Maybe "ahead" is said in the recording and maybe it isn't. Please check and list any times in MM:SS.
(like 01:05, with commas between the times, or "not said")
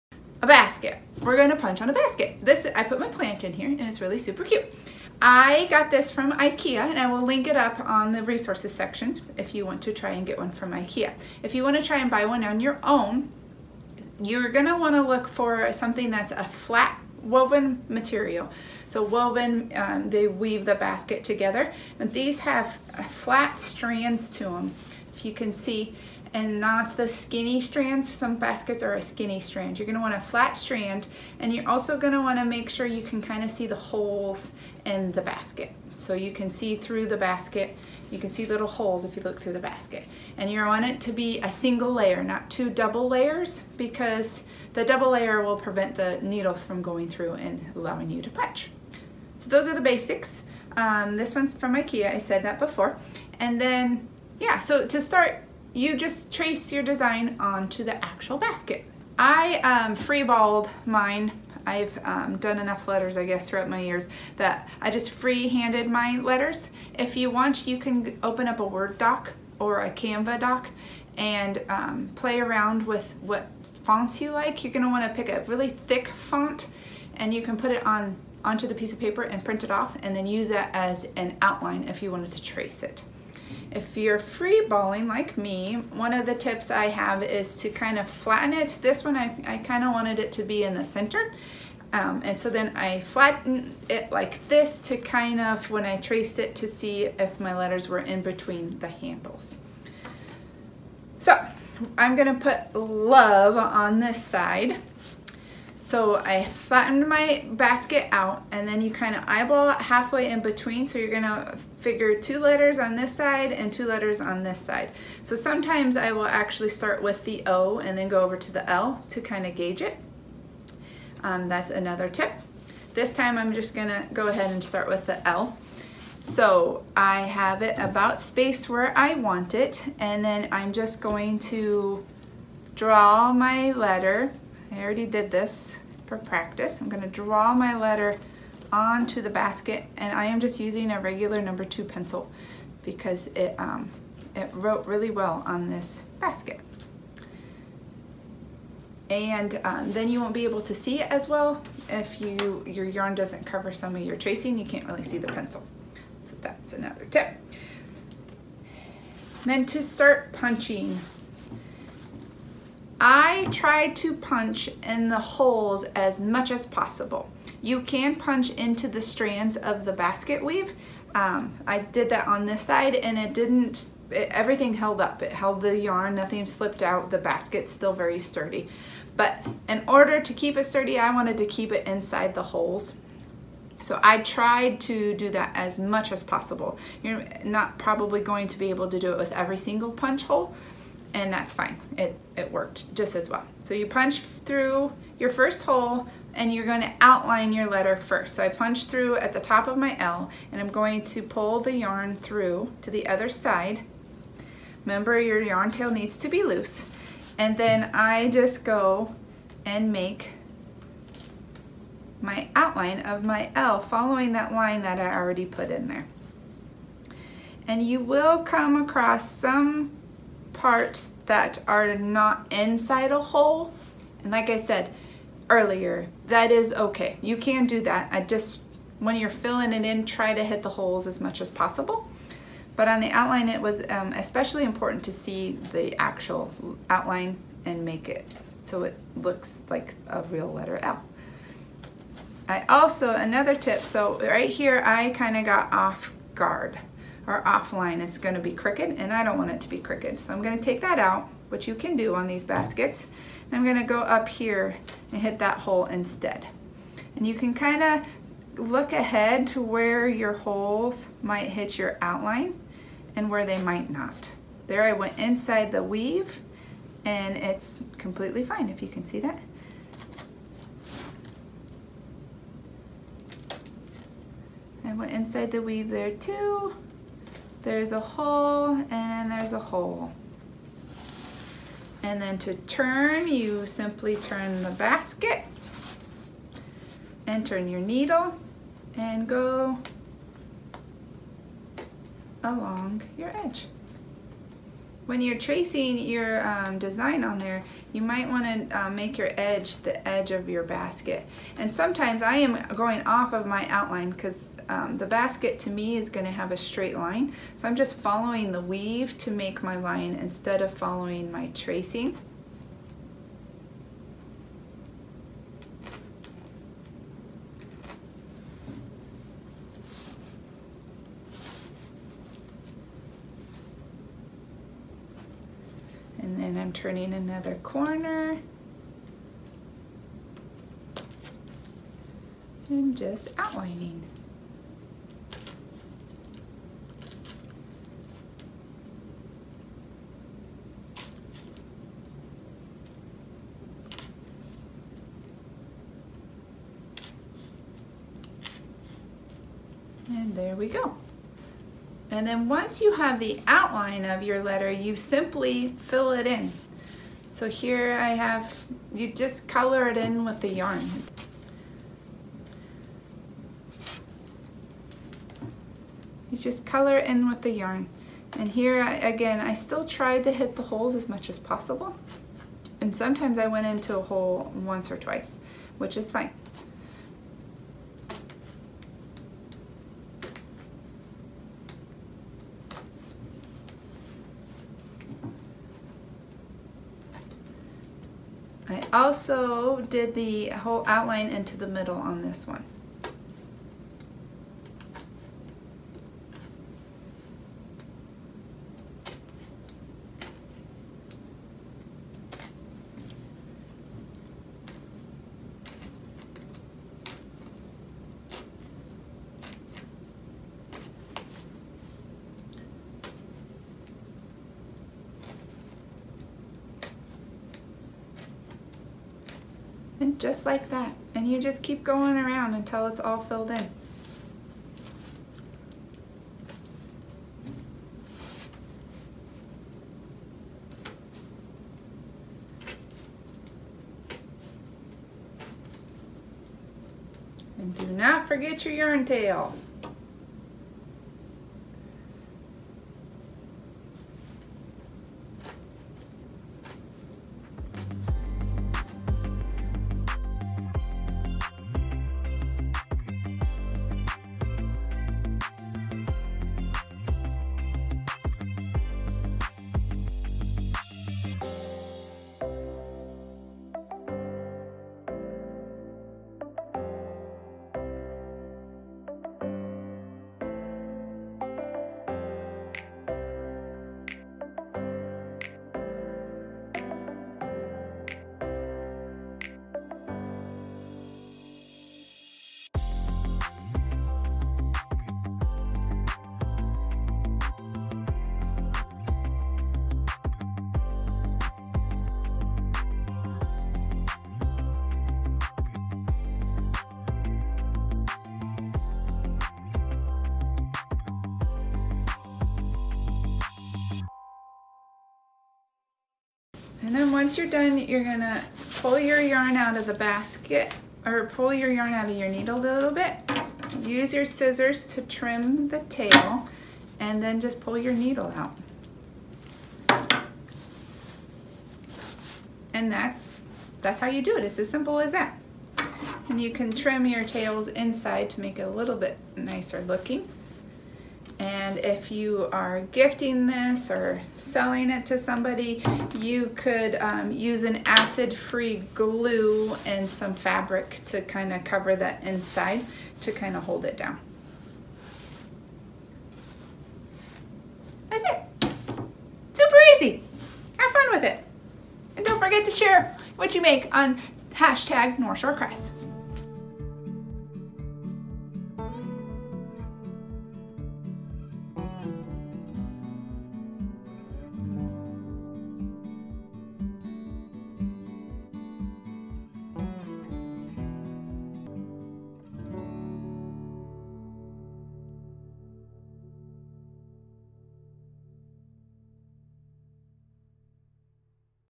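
02:04, 04:18.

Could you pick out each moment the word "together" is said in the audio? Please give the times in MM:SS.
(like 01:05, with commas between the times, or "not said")
00:21.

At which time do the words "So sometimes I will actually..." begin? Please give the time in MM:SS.
01:55.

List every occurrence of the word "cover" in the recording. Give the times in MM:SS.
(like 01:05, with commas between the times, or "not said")
02:33, 09:01.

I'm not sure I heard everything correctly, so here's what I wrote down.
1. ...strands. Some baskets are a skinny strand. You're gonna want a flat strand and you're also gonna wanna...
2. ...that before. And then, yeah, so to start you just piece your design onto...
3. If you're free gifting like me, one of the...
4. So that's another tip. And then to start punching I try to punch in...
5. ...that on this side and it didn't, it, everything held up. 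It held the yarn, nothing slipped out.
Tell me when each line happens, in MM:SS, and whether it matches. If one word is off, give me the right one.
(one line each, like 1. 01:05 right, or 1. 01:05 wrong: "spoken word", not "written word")
1. 00:27 right
2. 00:52 wrong: "trace", not "piece"
3. 01:23 wrong: "balling", not "gifting"
4. 02:36 right
5. 02:52 right.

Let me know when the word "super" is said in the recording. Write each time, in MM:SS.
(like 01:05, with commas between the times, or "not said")
00:04, 09:09.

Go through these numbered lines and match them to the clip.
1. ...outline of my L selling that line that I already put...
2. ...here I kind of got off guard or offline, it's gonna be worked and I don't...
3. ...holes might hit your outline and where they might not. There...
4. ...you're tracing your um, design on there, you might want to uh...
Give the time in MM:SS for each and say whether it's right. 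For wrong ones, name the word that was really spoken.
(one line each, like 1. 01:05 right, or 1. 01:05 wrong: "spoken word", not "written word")
1. 03:32 wrong: "following", not "selling"
2. 04:04 wrong: "crooked", not "worked"
3. 04:20 right
4. 04:55 right.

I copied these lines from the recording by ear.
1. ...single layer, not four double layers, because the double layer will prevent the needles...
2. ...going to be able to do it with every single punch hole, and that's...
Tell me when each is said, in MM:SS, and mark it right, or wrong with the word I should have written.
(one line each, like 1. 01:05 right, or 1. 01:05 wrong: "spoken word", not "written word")
1. 00:41 wrong: "two", not "four"
2. 03:08 right.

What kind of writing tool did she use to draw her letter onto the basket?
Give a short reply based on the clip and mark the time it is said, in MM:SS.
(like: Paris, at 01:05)
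number 2 pencil, at 02:21.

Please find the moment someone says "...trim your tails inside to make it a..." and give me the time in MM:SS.
08:46.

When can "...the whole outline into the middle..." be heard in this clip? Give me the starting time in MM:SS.
06:30.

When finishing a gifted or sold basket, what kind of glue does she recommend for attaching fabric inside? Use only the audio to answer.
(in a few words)
acid-free glue.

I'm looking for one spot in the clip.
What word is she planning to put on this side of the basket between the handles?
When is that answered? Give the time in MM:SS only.
01:42.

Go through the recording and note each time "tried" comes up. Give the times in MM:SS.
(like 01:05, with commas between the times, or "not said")
03:04, 06:09.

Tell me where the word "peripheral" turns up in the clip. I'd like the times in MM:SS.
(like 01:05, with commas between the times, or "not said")
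not said.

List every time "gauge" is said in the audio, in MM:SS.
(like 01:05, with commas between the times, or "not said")
01:59.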